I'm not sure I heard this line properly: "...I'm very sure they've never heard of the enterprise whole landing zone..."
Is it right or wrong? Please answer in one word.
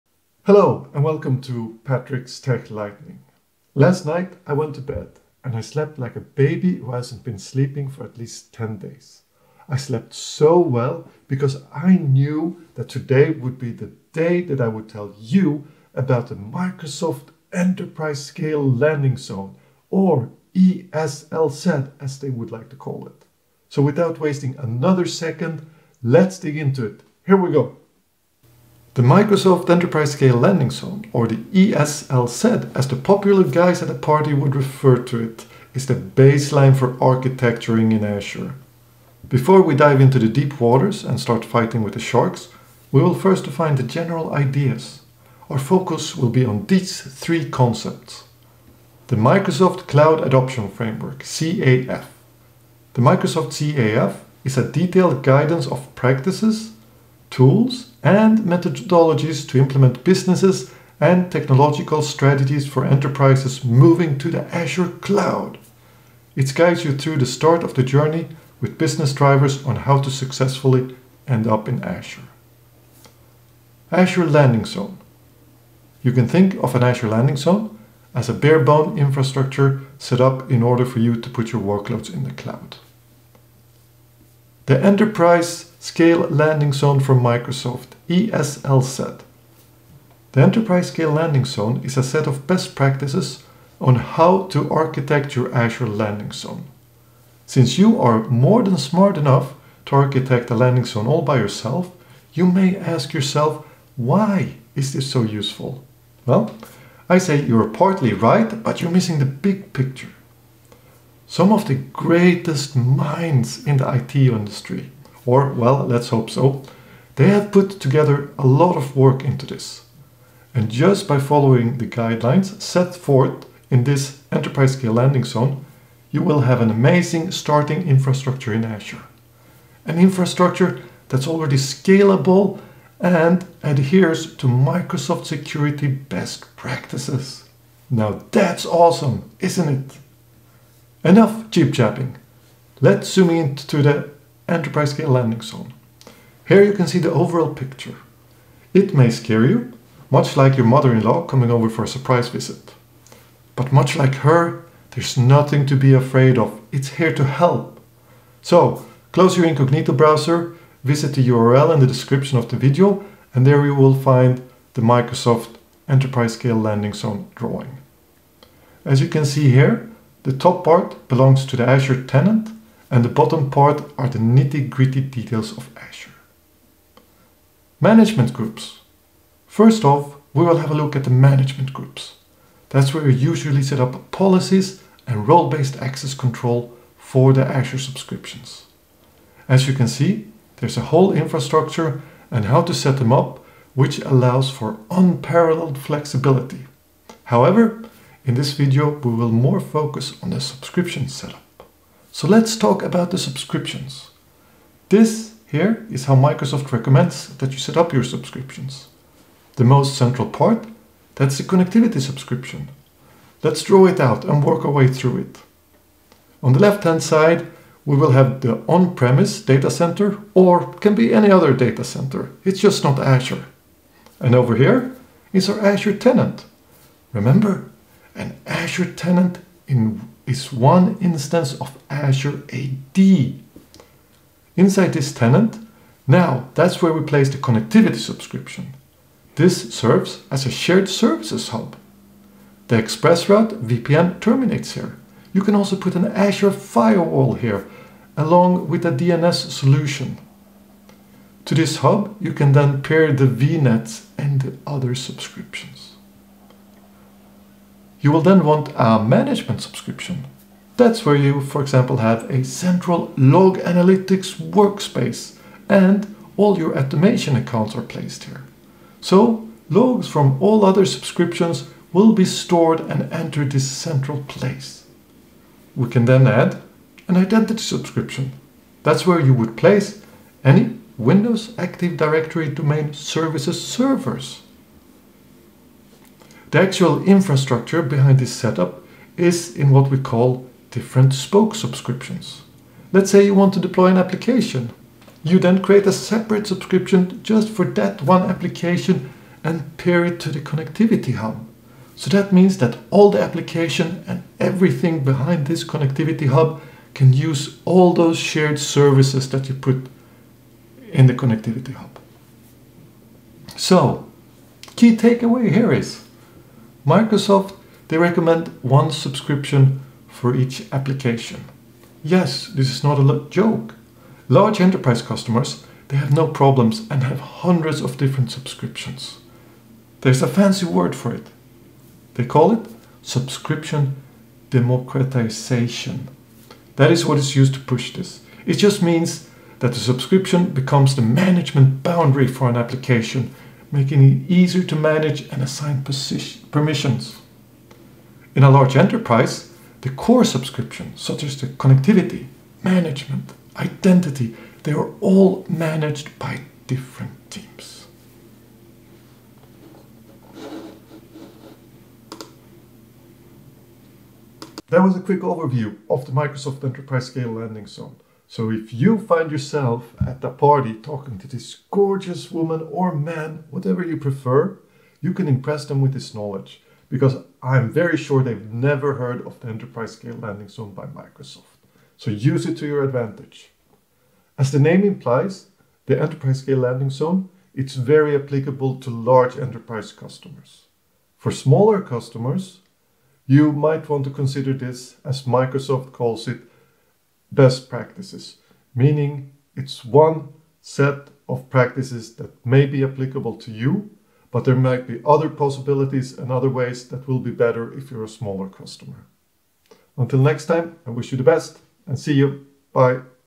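wrong.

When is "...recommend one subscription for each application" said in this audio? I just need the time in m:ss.
5:17.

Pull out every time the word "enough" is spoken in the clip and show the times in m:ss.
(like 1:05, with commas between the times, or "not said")
1:39, 2:21.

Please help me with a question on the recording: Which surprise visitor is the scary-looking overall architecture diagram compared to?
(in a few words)
mother-in-law.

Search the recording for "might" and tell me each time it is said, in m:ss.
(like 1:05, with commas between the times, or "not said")
6:33, 6:44.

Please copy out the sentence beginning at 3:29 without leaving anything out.
The most central part, that's the connectivity subscription.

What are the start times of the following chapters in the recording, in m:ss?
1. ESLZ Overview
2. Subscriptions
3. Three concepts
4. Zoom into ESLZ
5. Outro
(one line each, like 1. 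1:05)
1. 0:28
2. 3:23
3. 0:47
4. 2:21
5. 6:03.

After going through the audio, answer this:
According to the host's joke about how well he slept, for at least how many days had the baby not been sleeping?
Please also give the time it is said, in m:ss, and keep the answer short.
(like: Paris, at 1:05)
10, at 0:08.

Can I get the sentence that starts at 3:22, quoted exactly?
So let's talk about the subscriptions.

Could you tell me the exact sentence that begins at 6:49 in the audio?
Until next time, I wish you the best and see you.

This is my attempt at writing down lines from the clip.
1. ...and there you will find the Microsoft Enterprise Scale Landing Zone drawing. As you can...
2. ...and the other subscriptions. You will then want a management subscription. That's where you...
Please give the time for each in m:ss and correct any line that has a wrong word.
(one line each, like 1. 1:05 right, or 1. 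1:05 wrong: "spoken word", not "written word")
1. 2:43 right
2. 4:14 right.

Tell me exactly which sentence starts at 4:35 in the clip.
We can then add an identity subscription.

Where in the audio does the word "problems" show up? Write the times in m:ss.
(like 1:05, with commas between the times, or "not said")
5:26.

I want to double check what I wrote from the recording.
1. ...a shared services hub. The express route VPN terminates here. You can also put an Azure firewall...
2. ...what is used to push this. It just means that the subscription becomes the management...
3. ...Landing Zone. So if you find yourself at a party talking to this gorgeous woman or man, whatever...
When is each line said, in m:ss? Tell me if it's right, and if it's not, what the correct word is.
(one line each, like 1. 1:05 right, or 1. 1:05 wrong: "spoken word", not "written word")
1. 4:00 right
2. 5:37 right
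3. 6:07 right.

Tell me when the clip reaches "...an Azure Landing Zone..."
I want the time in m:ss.
1:16.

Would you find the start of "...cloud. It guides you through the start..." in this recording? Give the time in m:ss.
1:04.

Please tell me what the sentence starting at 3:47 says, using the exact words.
Remember, and Azure Tenant in, is one instance of Azure AD.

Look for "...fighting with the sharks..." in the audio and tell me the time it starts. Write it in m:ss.
0:41.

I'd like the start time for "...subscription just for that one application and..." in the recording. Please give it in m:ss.
4:56.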